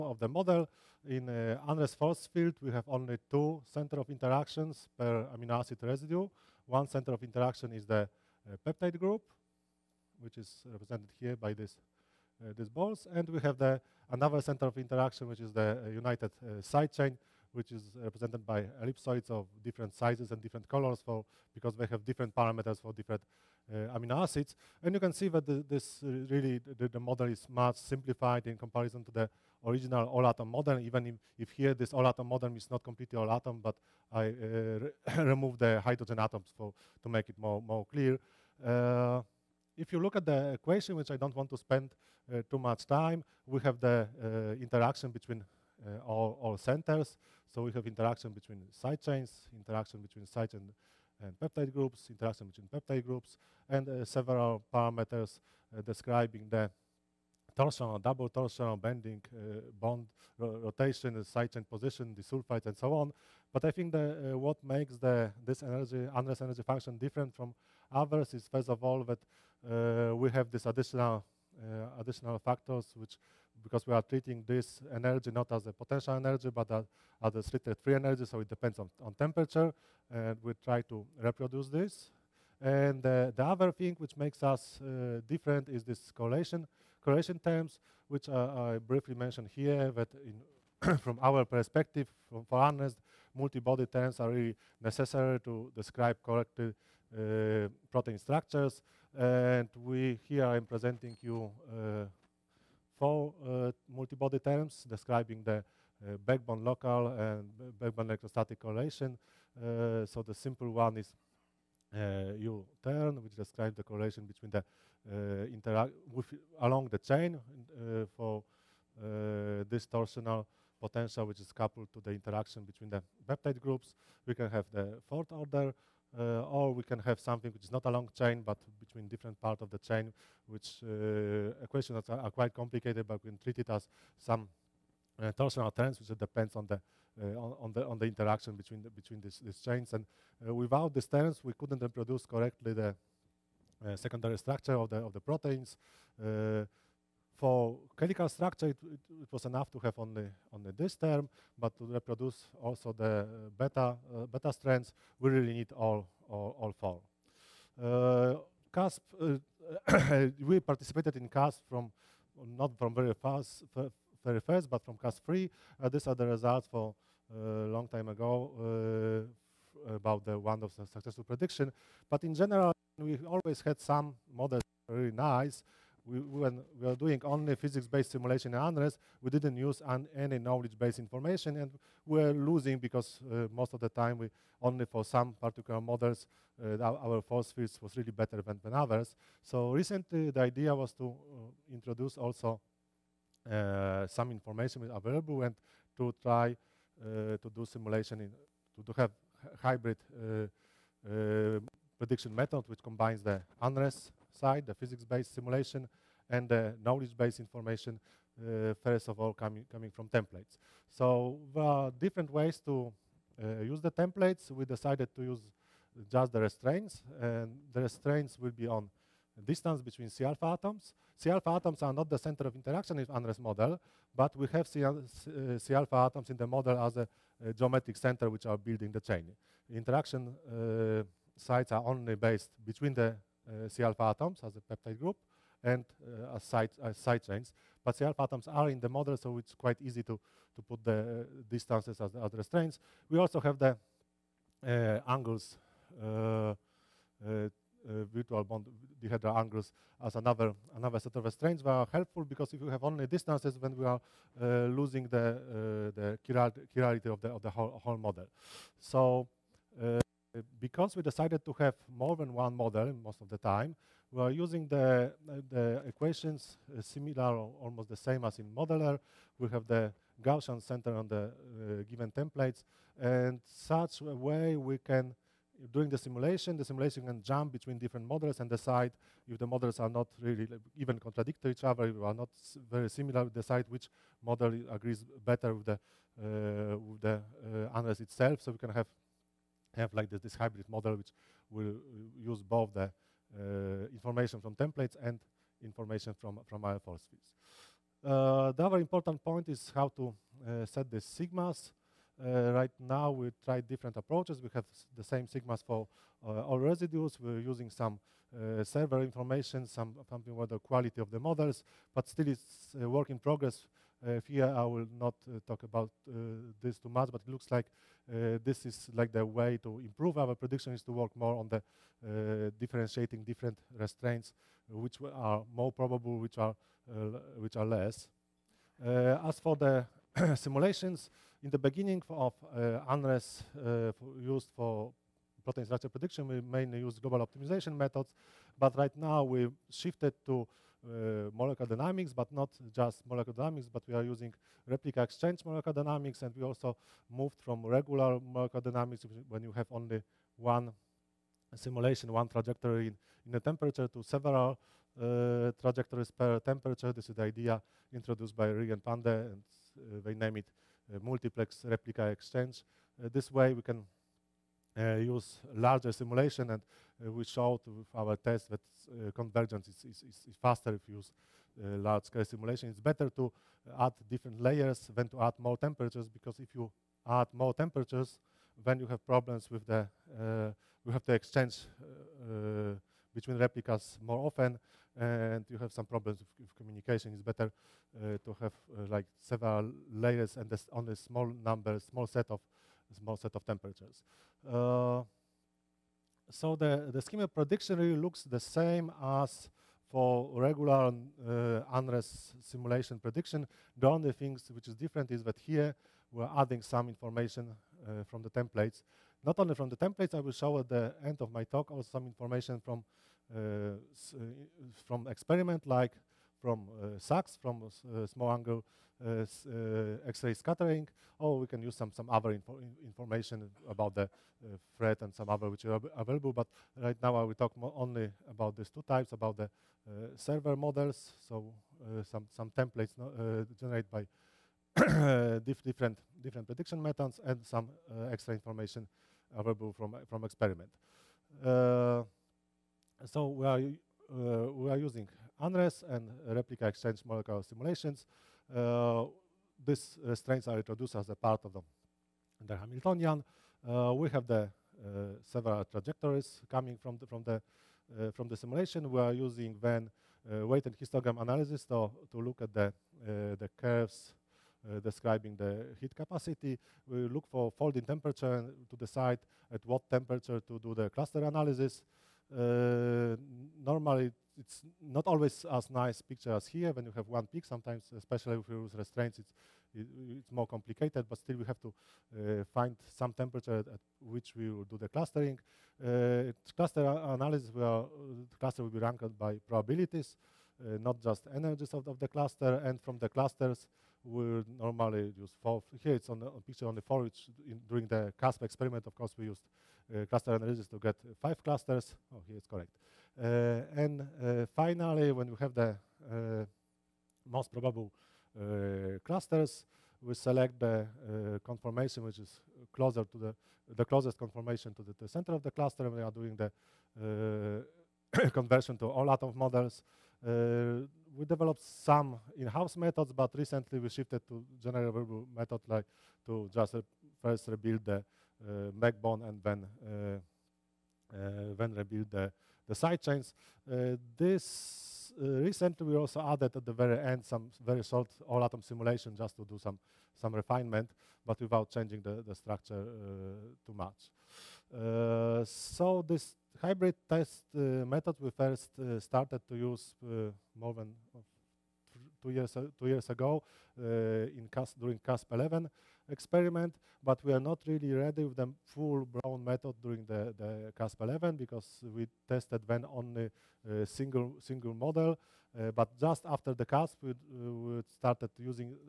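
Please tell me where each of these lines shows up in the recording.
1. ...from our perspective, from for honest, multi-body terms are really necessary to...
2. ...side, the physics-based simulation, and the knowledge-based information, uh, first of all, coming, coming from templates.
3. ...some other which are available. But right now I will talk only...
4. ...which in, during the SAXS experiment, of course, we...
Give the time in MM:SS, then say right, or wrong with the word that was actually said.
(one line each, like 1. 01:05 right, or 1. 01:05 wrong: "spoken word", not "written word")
1. 01:31 right
2. 03:24 right
3. 07:05 right
4. 08:17 wrong: "CASP", not "SAXS".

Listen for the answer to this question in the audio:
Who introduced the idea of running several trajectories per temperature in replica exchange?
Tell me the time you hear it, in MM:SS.
05:58.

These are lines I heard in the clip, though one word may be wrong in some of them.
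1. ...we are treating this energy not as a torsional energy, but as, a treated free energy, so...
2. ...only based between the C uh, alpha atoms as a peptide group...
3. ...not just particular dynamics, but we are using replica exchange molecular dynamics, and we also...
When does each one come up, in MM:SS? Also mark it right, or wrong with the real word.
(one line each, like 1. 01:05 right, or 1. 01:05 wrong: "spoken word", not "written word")
1. 01:13 wrong: "potential", not "torsional"
2. 03:51 right
3. 05:42 wrong: "molecular", not "particular".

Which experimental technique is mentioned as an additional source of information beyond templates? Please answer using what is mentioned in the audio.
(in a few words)
SAXS.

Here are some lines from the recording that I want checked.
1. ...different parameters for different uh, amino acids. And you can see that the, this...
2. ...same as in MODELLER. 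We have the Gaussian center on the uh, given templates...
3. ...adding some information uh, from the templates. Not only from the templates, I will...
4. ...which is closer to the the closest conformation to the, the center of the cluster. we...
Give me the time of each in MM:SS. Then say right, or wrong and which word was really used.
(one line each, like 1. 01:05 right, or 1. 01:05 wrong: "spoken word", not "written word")
1. 00:22 right
2. 04:27 right
3. 06:46 right
4. 08:32 right.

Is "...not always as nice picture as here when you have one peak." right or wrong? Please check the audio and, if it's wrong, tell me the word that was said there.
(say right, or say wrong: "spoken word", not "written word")
right.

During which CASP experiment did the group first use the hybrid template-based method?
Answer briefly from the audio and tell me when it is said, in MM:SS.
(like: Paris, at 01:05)
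CASP 11, at 09:14.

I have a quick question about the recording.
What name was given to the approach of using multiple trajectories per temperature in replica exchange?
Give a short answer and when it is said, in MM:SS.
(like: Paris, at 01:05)
Multiplex replica exchange, at 06:01.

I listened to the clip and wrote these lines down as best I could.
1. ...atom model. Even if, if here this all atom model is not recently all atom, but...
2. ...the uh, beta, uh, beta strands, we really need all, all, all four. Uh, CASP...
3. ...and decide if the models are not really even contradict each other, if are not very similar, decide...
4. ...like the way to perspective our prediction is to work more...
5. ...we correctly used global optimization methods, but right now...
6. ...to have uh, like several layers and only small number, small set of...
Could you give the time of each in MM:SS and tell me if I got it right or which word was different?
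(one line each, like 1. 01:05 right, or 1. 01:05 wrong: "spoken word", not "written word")
1. 00:30 wrong: "completely", not "recently"
2. 02:32 right
3. 04:38 right
4. 05:18 wrong: "improve", not "perspective"
5. 05:36 wrong: "mainly", not "correctly"
6. 06:28 right.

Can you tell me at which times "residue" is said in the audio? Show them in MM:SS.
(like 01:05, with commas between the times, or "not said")
00:05, 05:06.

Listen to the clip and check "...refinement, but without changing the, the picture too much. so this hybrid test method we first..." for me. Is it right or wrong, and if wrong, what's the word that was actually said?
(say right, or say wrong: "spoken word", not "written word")
wrong: "structure", not "picture".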